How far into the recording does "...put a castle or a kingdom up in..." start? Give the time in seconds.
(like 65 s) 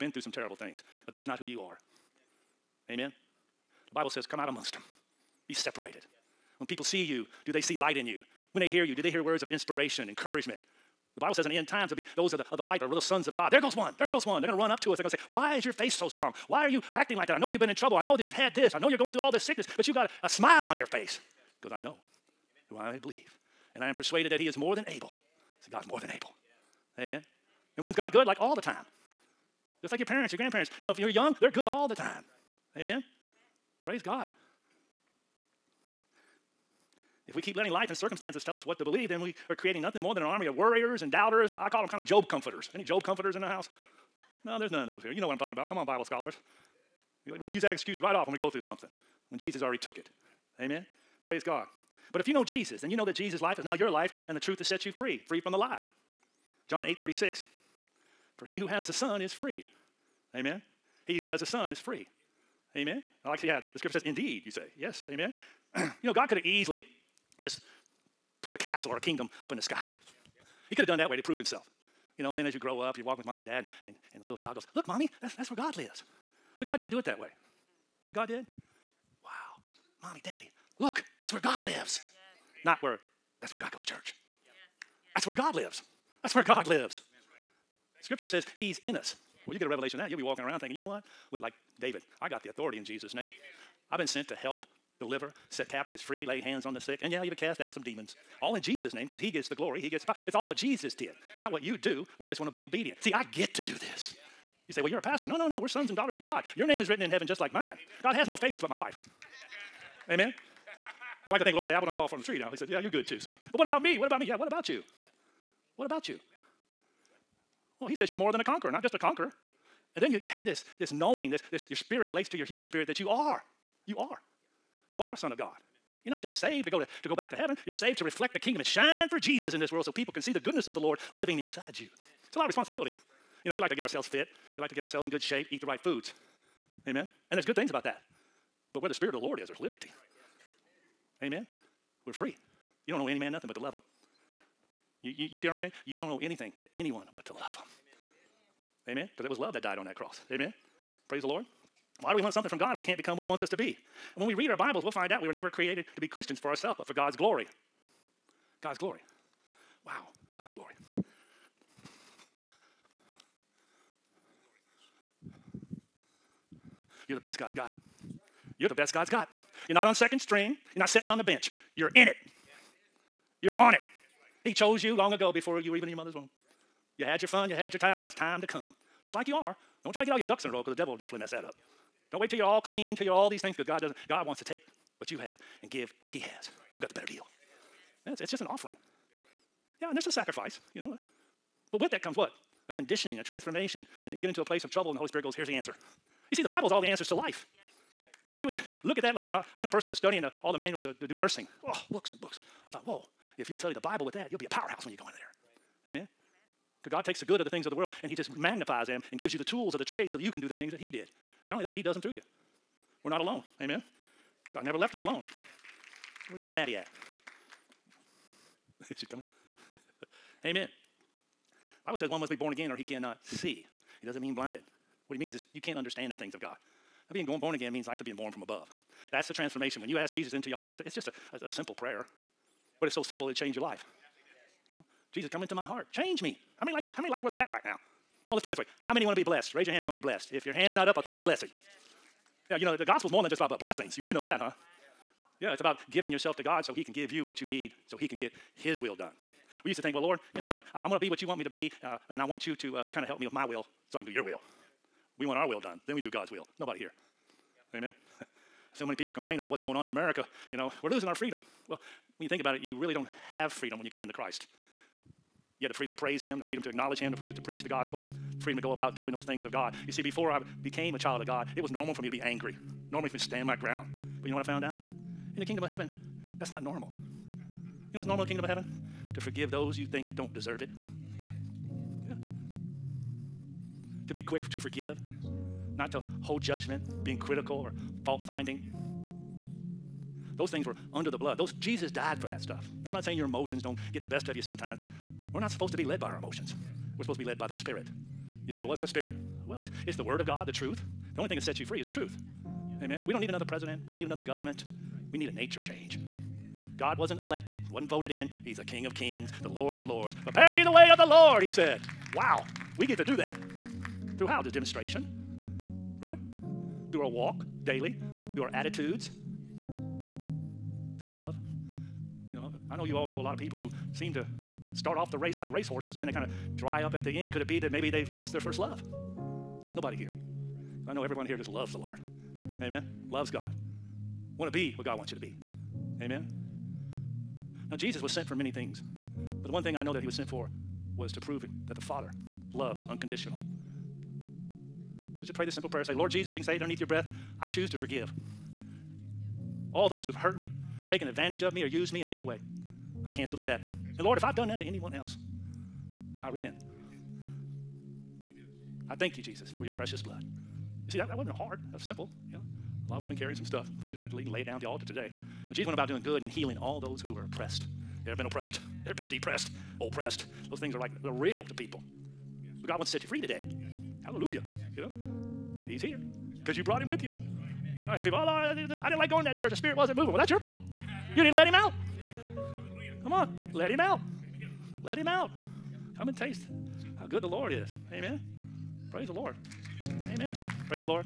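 68 s.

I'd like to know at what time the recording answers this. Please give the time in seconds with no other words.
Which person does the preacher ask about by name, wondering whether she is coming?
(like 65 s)
216 s.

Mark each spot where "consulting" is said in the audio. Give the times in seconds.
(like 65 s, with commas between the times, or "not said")
not said.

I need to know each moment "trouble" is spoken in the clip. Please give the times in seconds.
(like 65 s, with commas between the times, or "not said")
17 s, 194 s.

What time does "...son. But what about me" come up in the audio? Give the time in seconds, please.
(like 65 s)
113 s.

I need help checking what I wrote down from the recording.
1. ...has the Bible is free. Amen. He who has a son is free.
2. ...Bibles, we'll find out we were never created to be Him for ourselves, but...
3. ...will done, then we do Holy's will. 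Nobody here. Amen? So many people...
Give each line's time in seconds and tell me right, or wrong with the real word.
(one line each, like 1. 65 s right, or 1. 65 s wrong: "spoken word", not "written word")
1. 58 s wrong: "Son", not "Bible"
2. 154 s wrong: "Christians", not "Him"
3. 255 s wrong: "God", not "Holy".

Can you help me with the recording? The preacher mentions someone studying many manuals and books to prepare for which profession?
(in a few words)
nursing.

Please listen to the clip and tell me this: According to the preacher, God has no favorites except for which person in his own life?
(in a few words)
my wife.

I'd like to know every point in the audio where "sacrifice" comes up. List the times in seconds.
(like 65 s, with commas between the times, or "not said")
190 s.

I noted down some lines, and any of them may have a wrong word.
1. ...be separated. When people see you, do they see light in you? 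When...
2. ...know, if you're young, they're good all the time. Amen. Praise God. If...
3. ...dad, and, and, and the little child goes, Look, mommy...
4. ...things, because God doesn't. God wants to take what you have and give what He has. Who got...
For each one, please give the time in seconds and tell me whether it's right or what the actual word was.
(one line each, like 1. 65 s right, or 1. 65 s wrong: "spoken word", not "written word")
1. 5 s right
2. 30 s right
3. 73 s right
4. 183 s right.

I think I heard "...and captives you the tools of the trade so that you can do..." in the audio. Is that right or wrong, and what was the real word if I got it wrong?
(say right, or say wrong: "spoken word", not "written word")
wrong: "gives", not "captives".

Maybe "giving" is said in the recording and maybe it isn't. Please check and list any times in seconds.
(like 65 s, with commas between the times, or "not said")
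245 s.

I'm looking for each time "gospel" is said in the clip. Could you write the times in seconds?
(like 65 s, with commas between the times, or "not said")
242 s, 267 s.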